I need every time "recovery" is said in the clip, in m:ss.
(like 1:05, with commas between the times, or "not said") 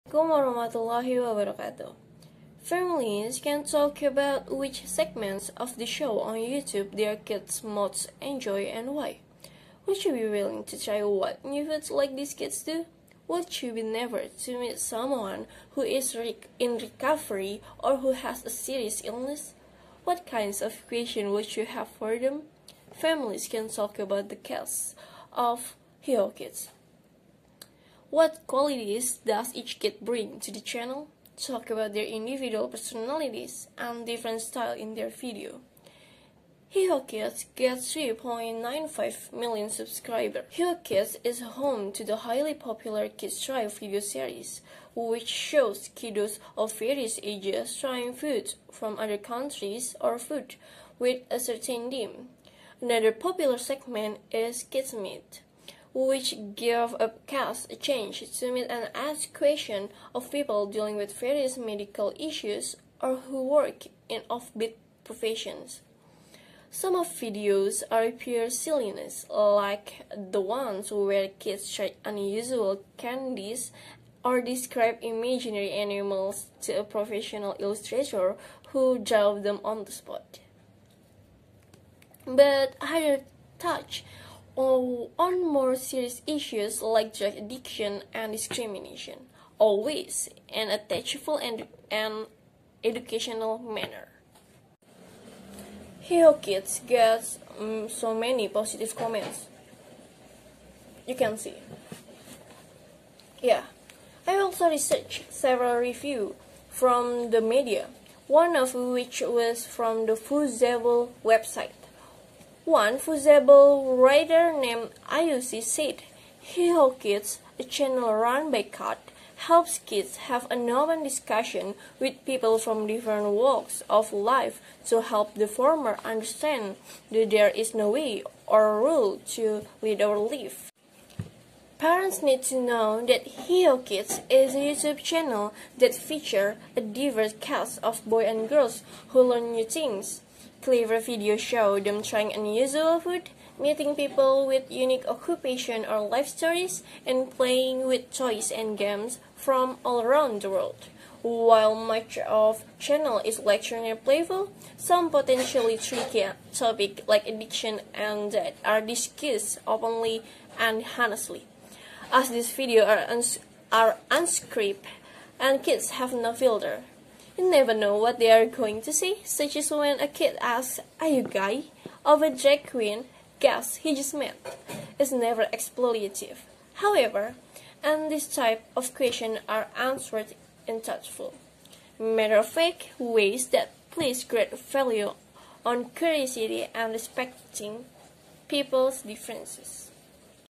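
0:16.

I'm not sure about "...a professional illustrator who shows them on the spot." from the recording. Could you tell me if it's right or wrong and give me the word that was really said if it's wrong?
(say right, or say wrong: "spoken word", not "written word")
wrong: "draws", not "shows".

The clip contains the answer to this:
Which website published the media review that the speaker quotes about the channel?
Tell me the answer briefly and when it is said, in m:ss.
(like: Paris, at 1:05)
Food Devil, at 1:50.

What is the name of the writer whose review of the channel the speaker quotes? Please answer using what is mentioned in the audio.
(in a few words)
Ayushi.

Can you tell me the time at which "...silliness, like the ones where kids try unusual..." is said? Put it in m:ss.
1:08.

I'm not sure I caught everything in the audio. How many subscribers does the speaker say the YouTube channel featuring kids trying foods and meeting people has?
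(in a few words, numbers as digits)
3.95 million.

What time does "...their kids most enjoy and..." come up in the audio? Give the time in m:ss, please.
0:06.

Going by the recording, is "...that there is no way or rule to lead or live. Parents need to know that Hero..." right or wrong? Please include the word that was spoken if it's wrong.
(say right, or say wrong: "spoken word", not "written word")
right.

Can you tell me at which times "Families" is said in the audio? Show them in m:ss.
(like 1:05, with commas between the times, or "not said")
0:02, 0:22.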